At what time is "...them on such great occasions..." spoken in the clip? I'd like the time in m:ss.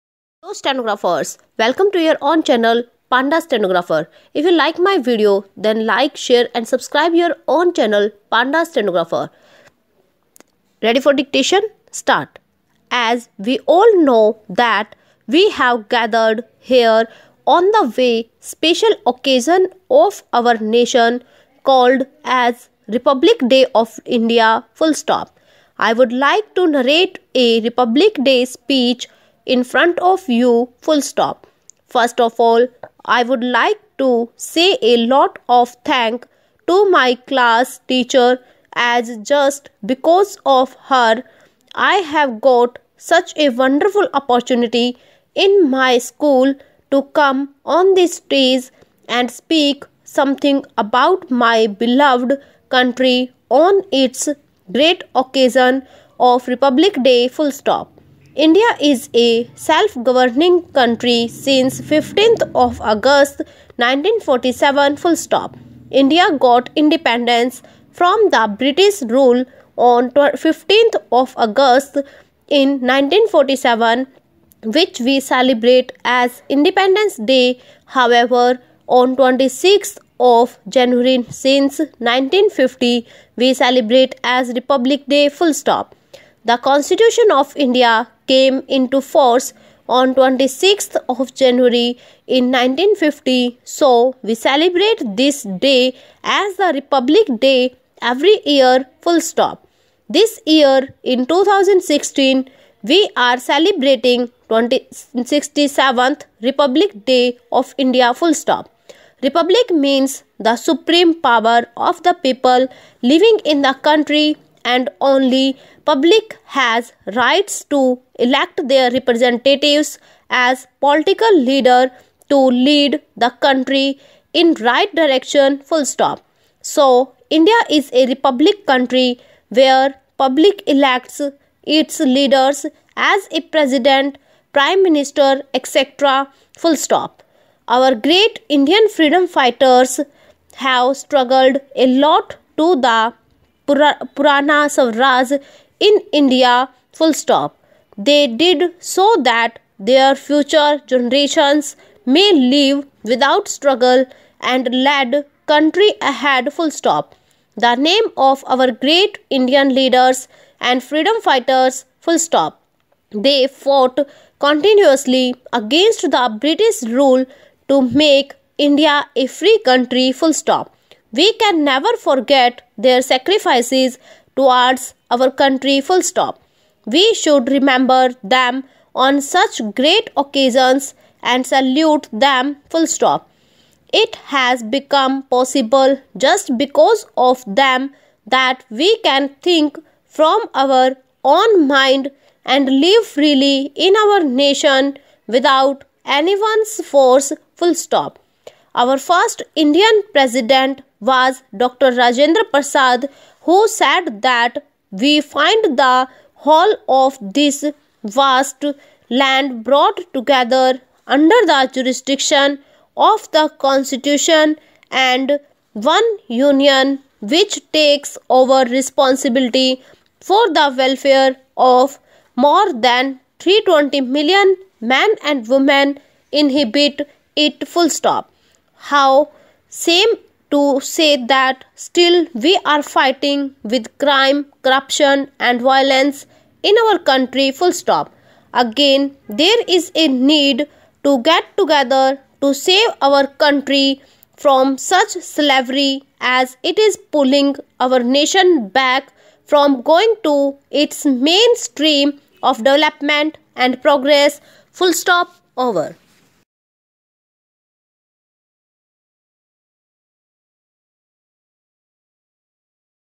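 2:58.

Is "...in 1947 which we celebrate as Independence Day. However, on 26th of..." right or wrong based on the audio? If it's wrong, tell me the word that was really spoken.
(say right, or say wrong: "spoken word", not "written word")
right.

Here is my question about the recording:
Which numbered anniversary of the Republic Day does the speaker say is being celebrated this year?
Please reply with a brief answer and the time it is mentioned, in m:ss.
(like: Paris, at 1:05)
67th, at 1:44.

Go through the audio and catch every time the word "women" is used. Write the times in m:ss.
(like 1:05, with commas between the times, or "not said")
3:45.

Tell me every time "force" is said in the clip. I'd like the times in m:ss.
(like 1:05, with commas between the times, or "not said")
1:29, 3:16.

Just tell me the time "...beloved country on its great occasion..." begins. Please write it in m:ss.
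0:51.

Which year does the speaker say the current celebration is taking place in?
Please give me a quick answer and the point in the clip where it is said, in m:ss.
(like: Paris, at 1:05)
2016, at 1:41.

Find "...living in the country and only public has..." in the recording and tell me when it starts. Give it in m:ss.
1:53.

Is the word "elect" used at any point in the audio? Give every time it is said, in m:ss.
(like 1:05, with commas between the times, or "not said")
1:58, 2:10.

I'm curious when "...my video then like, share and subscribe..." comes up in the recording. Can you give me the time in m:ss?
0:04.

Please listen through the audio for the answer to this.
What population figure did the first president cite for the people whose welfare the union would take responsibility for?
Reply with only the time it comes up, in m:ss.
3:43.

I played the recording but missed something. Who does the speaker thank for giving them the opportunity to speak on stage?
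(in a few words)
Class teacher.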